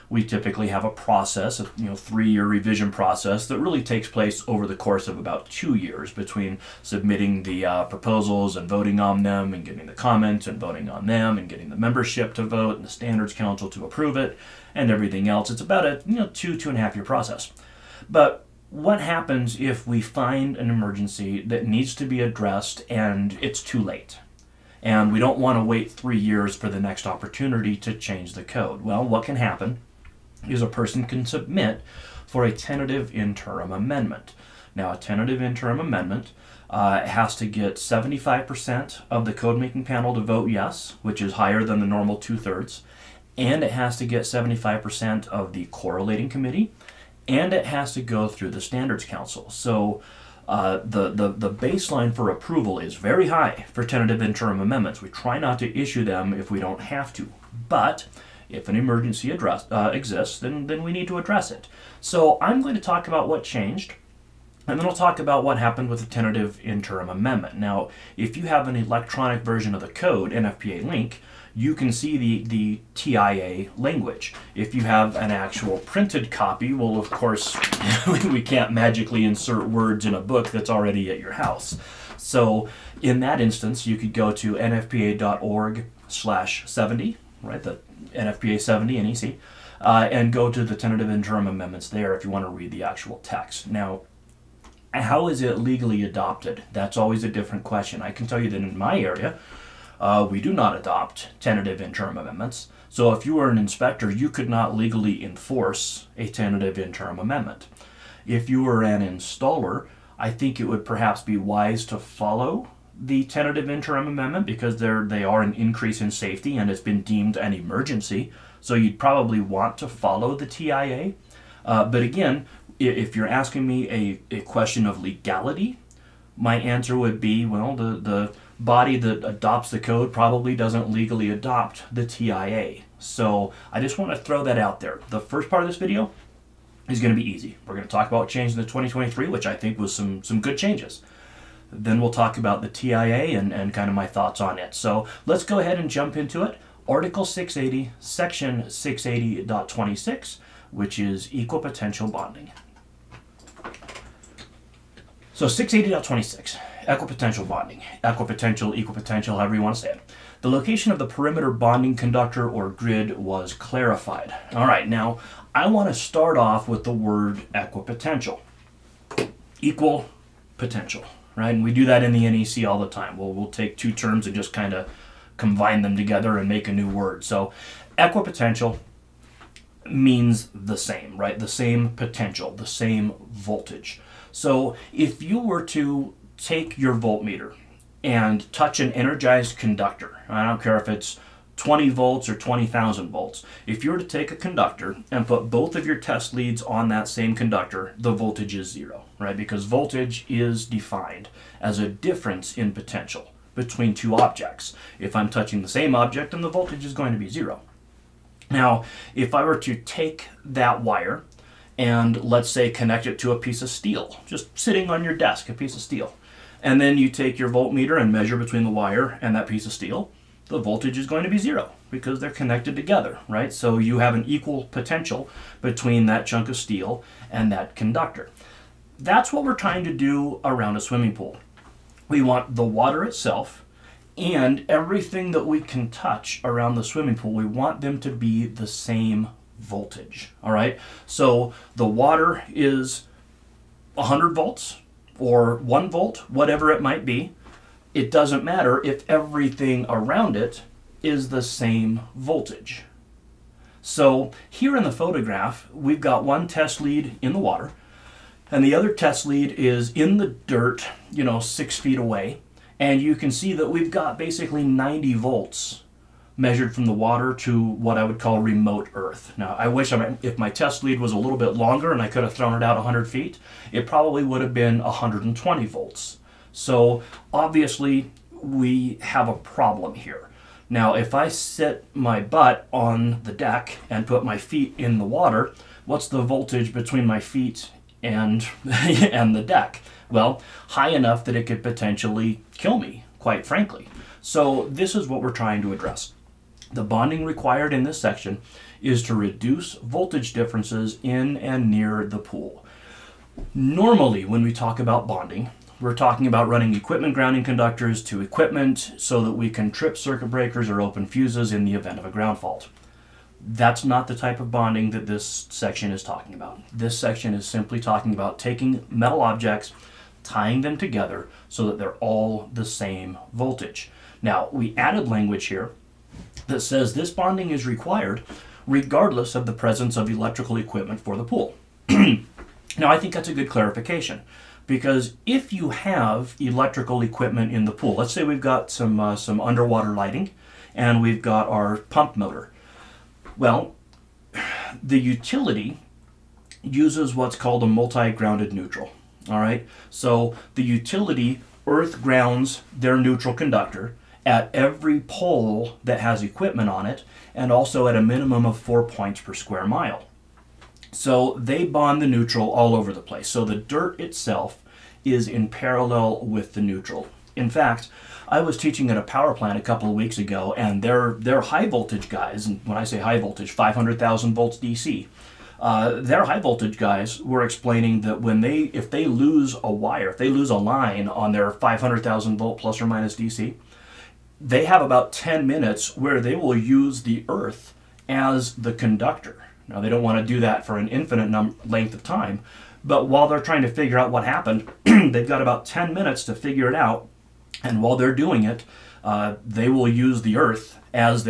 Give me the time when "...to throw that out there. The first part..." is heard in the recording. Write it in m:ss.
2:14.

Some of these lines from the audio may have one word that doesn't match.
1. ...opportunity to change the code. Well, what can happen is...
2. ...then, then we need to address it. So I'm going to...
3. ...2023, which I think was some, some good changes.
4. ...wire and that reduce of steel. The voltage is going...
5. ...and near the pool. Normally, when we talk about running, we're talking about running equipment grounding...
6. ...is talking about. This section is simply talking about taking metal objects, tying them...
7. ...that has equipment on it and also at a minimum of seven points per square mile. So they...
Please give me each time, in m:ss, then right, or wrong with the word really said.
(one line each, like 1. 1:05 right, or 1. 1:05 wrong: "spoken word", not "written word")
1. 0:27 right
2. 1:00 right
3. 2:18 right
4. 3:38 wrong: "piece", not "reduce"
5. 5:01 wrong: "bonding", not "running"
6. 5:15 right
7. 5:55 wrong: "four", not "seven".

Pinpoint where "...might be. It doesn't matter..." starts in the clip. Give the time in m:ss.
4:06.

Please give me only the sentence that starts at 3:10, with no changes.
I don't care if it's 20 volts or 20,000 volts.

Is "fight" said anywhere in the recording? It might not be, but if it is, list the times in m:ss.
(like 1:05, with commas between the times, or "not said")
not said.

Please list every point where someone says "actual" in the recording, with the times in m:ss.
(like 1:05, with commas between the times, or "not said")
1:15, 1:32.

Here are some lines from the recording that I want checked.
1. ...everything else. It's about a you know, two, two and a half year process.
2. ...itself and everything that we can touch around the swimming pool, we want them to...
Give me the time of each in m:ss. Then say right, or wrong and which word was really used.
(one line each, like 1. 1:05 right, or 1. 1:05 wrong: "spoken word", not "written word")
1. 0:14 right
2. 3:53 right.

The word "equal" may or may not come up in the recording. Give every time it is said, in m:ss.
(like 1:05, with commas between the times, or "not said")
2:31, 2:38, 2:49, 3:44.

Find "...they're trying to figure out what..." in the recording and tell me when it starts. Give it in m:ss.
6:33.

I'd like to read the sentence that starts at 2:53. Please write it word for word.
Well, we'll take two terms and just kind of combine them together and make a new word.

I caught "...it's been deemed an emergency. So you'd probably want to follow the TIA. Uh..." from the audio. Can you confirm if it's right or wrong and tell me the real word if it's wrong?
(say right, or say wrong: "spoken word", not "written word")
right.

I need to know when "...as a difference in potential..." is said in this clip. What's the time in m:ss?
3:21.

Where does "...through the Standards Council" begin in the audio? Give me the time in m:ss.
0:48.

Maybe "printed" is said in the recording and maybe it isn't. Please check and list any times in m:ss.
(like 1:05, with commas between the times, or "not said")
1:15.